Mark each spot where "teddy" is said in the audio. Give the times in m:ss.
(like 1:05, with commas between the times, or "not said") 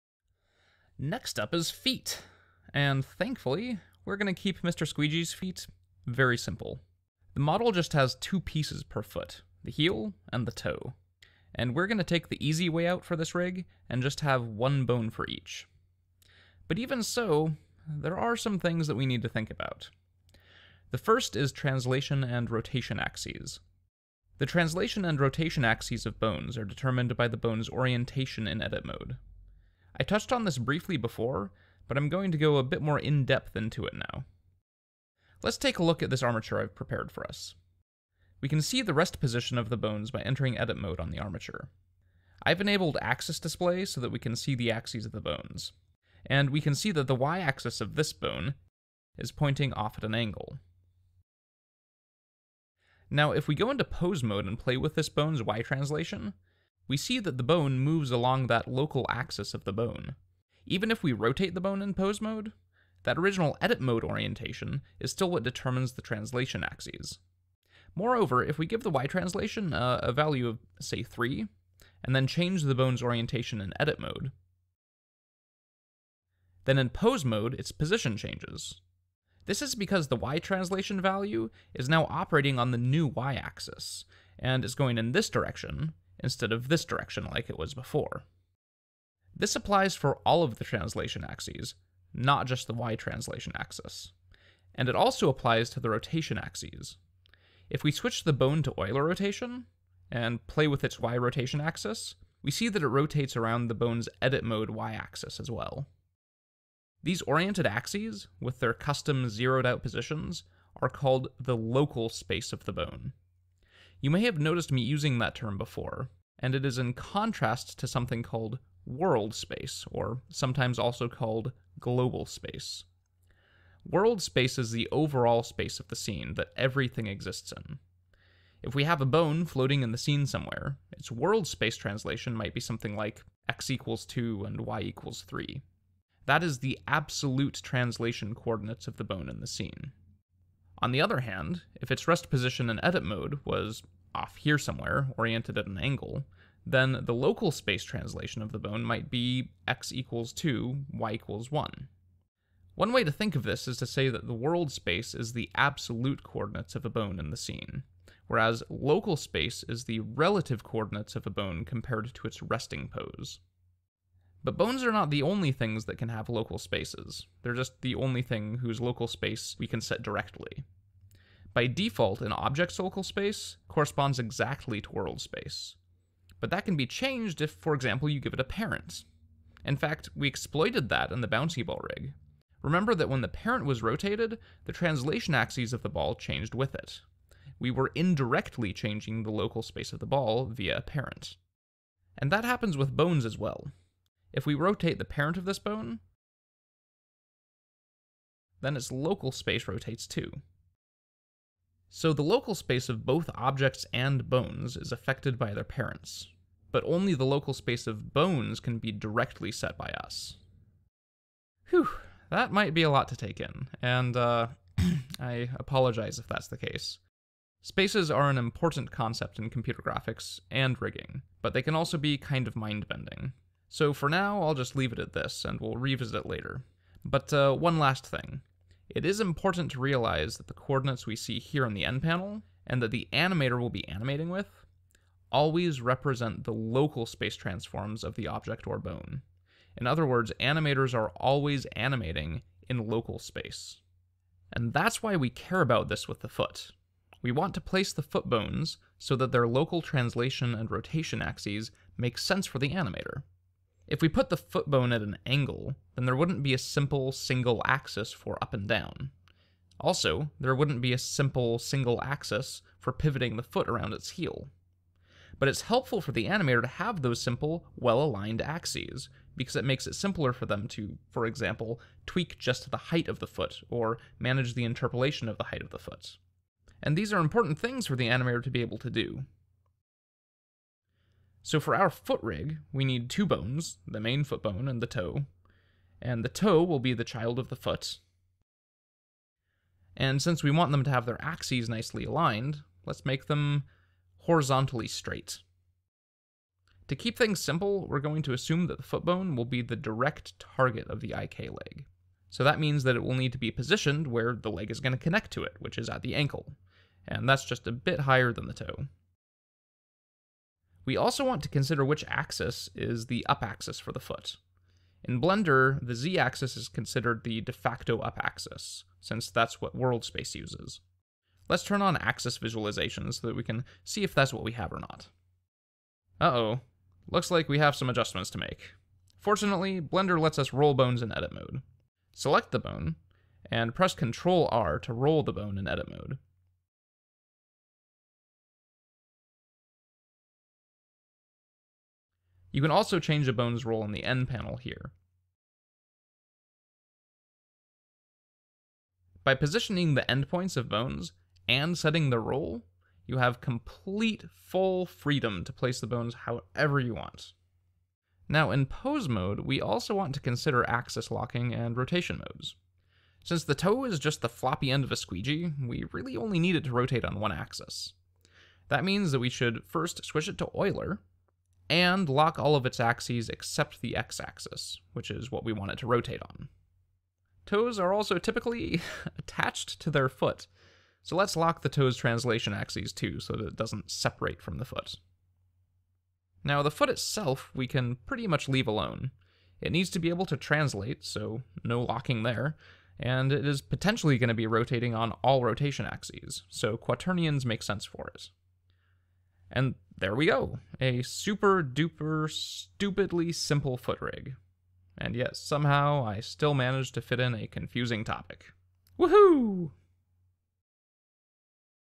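not said.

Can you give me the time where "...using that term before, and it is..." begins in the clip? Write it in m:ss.
1:54.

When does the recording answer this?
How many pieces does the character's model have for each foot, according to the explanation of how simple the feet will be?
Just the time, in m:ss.
0:08.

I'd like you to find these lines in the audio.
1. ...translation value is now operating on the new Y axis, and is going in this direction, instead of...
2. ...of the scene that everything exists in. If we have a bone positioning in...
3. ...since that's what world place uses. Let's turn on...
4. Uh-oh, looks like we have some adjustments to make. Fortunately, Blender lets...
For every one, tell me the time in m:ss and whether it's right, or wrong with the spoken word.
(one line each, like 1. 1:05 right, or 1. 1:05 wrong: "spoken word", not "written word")
1. 1:20 right
2. 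2:05 wrong: "floating", not "positioning"
3. 5:18 wrong: "space", not "place"
4. 5:26 right.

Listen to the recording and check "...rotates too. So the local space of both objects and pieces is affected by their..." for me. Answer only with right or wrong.
wrong.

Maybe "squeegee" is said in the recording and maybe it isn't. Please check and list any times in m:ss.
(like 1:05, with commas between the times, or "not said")
0:04, 6:04.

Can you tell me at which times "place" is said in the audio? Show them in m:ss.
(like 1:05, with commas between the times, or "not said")
4:07, 5:55.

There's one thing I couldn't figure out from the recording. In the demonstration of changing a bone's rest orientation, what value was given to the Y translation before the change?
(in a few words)
3.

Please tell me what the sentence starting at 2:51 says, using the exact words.
By default, an object's local space corresponds exactly to world space.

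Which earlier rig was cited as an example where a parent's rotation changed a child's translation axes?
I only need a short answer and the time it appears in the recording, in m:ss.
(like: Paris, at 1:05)
bouncy ball rig, at 3:01.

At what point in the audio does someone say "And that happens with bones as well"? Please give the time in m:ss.
3:12.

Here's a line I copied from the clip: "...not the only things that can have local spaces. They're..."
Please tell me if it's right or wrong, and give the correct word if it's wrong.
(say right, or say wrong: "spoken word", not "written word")
right.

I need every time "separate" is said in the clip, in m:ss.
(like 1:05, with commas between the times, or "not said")
6:23.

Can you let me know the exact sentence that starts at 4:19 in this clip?
Also, there wouldn't be a simple single axis for pivoting the foot around its heel.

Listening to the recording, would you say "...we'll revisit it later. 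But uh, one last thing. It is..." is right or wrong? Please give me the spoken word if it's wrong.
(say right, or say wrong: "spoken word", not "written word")
right.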